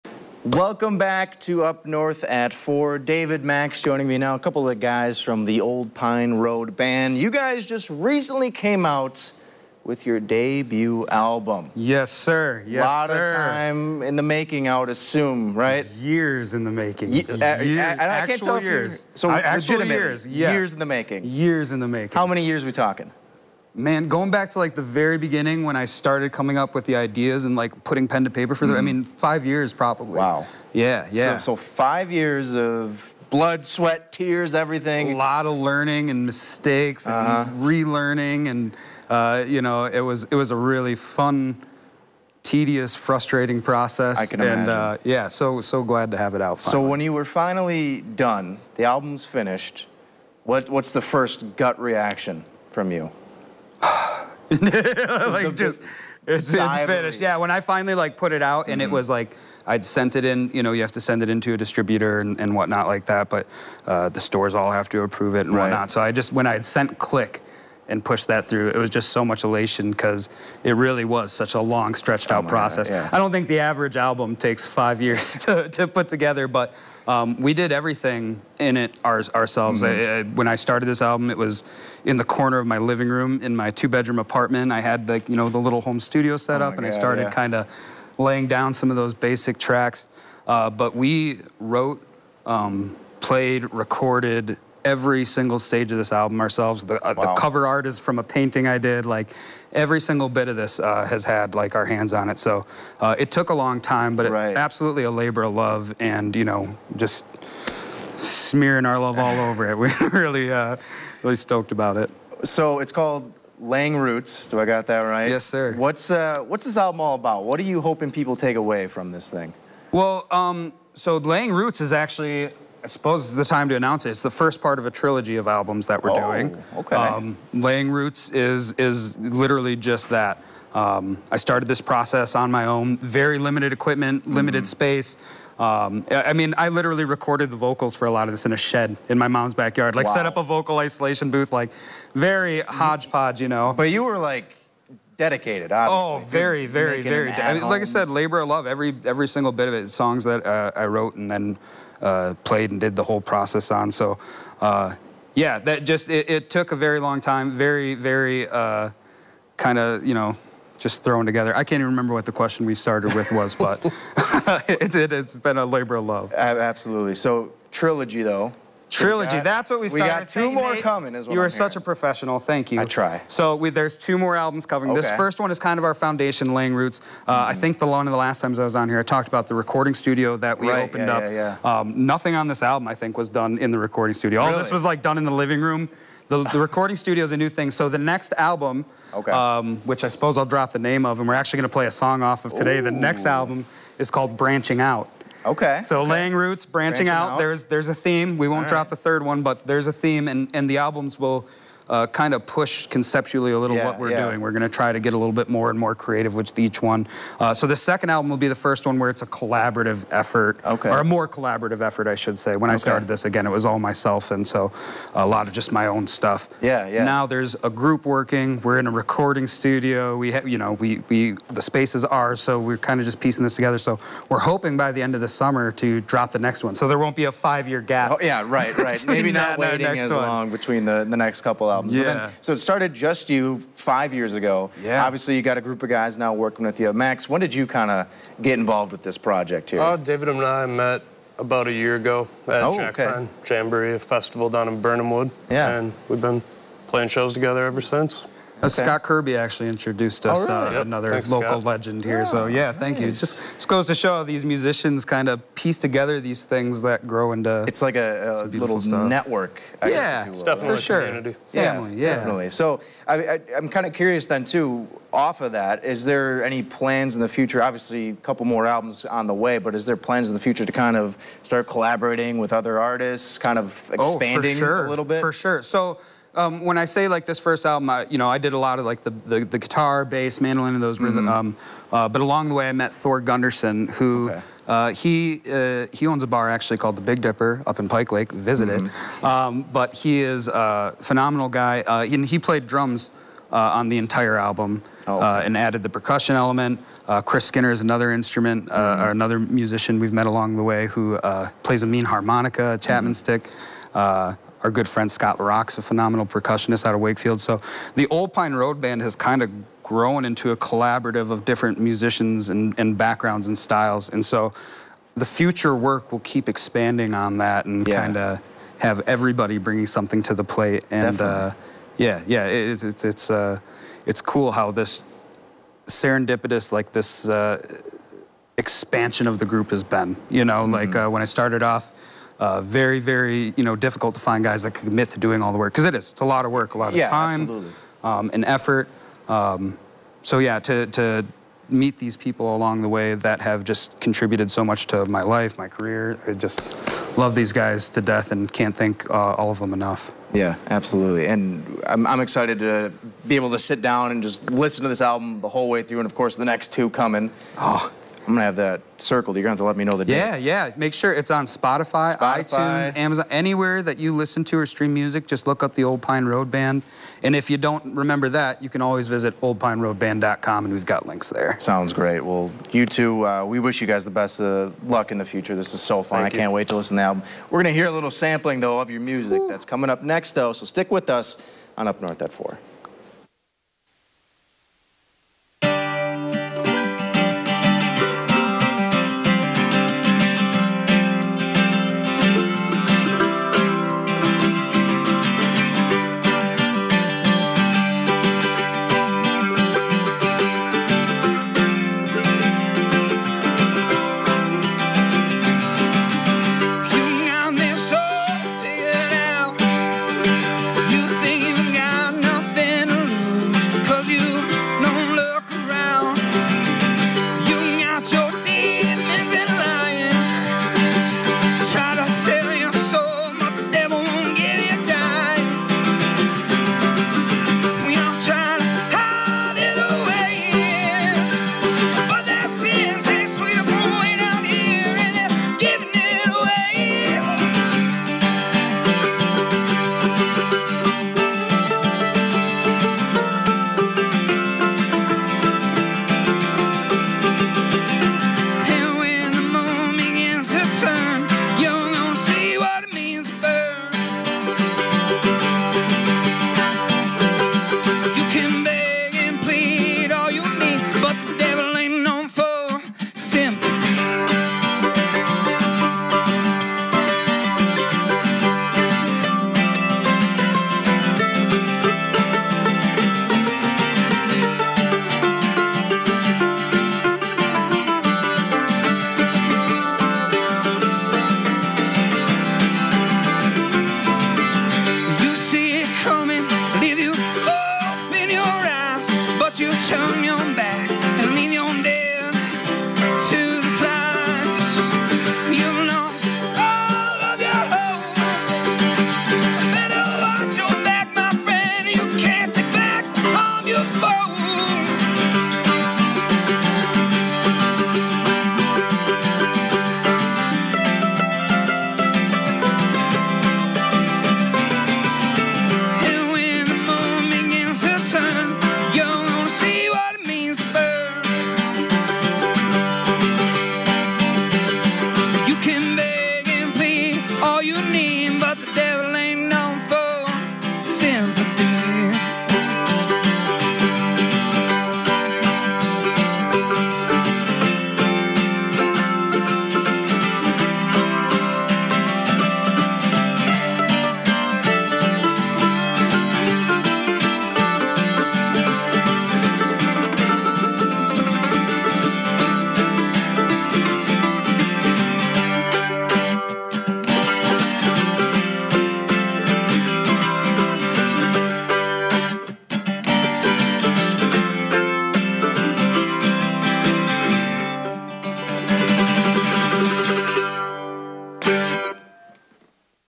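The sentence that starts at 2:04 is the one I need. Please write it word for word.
It's the first part of a trilogy of albums that we're oh, doing.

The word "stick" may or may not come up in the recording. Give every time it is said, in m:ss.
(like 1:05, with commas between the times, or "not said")
5:03, 6:20.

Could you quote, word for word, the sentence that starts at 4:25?
Off of that, is there any plans in the future?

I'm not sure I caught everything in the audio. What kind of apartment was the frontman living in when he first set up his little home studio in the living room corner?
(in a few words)
Two-bedroom.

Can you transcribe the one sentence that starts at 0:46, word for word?
So when you were finally done, the album's finished.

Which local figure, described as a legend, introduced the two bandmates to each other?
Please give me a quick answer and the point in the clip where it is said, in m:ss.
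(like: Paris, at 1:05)
Scott Kirby, at 4:08.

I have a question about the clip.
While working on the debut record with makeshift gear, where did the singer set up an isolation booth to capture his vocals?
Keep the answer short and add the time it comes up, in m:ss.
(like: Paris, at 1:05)
A shed, at 2:18.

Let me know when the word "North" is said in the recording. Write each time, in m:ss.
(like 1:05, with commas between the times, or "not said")
0:01, 6:22.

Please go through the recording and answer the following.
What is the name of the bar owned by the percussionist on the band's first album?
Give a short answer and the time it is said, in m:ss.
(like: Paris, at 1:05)
Big Dipper, at 4:47.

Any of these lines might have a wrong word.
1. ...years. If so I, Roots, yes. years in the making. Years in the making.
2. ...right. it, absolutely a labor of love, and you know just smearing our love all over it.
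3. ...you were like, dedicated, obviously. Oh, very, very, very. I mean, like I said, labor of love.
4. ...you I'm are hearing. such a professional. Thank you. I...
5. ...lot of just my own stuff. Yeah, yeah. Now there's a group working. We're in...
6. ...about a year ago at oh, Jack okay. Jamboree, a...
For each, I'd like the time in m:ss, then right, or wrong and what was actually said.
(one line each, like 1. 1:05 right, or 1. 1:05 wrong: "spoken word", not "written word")
1. 0:18 wrong: "Years", not "Roots"
2. 1:44 right
3. 2:23 right
4. 2:51 right
5. 3:35 right
6. 4:01 right.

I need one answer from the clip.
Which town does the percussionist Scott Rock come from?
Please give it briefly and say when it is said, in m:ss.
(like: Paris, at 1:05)
Wakefield, at 5:07.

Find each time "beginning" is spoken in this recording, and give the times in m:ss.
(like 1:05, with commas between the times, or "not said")
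0:25.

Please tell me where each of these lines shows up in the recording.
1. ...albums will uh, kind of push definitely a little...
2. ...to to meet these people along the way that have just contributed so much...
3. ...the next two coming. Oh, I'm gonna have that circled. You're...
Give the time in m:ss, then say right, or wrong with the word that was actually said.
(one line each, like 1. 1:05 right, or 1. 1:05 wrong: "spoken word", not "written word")
1. 3:20 wrong: "conceptually", not "definitely"
2. 5:40 right
3. 5:56 right.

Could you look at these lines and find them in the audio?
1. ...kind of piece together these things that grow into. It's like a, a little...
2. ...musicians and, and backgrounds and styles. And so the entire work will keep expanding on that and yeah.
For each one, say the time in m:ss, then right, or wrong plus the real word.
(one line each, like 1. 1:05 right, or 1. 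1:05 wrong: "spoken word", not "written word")
1. 4:15 right
2. 5:11 wrong: "future", not "entire".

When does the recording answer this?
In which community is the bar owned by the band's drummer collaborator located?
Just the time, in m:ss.
4:47.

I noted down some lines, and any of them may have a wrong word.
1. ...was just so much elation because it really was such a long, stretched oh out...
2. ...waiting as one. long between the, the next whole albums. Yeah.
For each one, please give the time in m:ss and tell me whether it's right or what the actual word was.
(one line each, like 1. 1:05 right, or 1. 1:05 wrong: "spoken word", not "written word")
1. 1:08 right
2. 3:49 wrong: "couple", not "whole".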